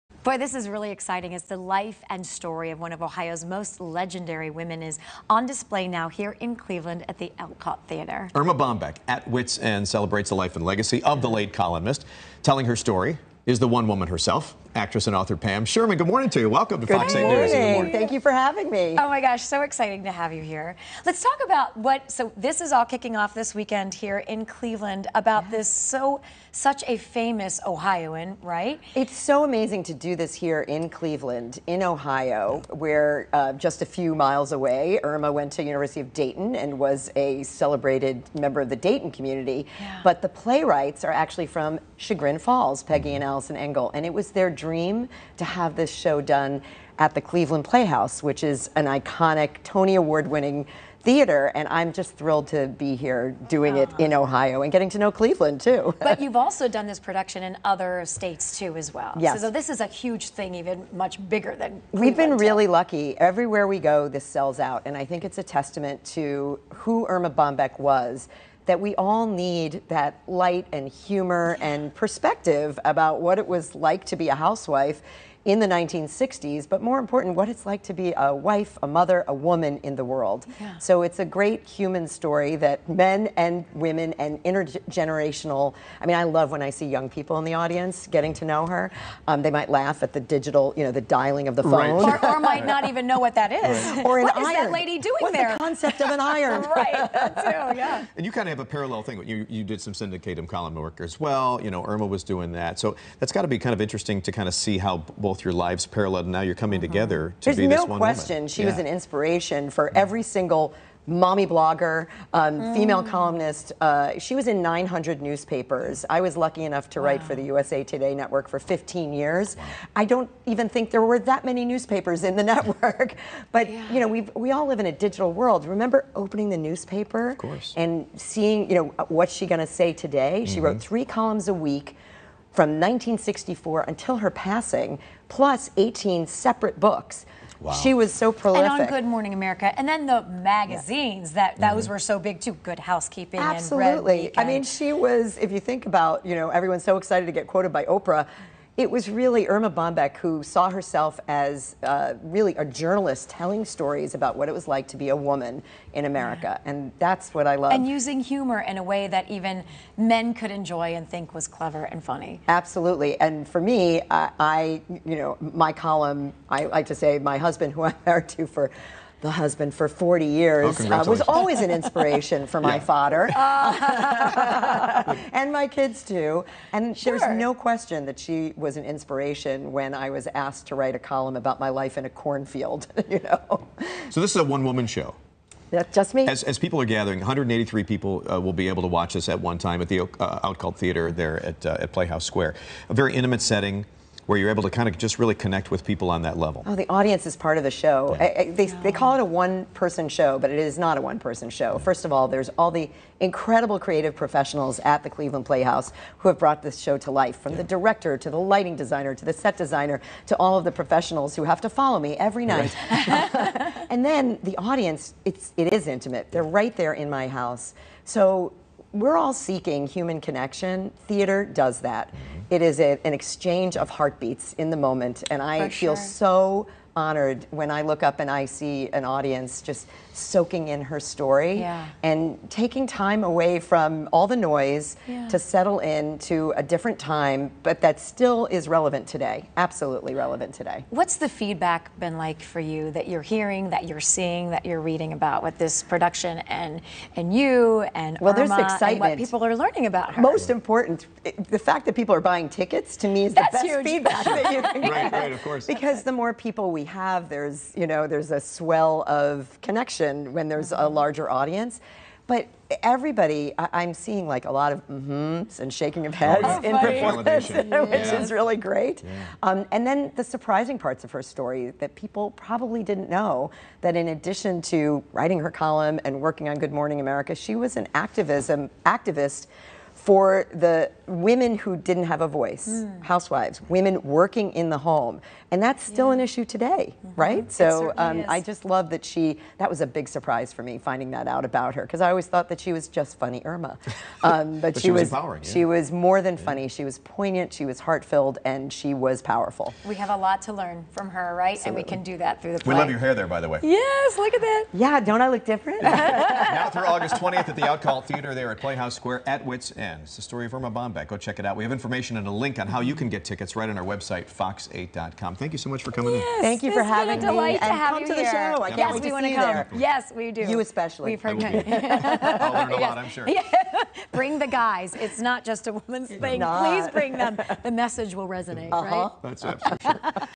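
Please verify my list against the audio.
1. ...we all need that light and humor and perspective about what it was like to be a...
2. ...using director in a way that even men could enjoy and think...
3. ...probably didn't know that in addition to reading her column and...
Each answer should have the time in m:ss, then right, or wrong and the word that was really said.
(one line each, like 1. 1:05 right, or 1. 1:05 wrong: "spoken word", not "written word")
1. 1:08 right
2. 2:37 wrong: "humor", not "director"
3. 4:32 wrong: "writing", not "reading".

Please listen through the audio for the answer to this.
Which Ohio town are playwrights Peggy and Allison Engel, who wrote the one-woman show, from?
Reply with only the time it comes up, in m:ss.
0:41.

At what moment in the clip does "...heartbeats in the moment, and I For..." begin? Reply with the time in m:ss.
3:43.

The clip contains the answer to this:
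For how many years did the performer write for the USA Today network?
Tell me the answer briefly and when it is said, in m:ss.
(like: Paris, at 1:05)
15, at 1:58.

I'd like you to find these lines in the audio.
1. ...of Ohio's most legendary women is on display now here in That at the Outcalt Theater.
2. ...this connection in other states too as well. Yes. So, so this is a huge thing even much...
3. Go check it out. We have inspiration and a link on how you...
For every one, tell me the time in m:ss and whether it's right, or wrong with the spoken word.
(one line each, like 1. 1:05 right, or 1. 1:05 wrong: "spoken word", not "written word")
1. 0:02 wrong: "Cleveland", not "That"
2. 0:56 wrong: "production", not "connection"
3. 5:11 wrong: "information", not "inspiration".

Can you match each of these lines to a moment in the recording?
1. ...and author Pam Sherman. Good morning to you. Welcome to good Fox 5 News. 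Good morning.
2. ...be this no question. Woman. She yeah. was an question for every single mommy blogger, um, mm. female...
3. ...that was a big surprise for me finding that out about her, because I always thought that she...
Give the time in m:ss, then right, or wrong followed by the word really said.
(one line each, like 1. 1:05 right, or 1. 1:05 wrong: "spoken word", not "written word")
1. 0:15 wrong: "8", not "5"
2. 1:47 wrong: "inspiration", not "question"
3. 4:49 right.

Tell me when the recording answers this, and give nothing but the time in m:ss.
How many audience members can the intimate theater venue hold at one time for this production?
3:07.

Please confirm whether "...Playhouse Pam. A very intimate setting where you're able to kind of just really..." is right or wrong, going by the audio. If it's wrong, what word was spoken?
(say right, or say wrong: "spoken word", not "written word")
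wrong: "Square", not "Pam".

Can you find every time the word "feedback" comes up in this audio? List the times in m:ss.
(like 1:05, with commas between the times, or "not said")
4:01, 4:13.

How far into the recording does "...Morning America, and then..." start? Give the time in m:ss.
2:19.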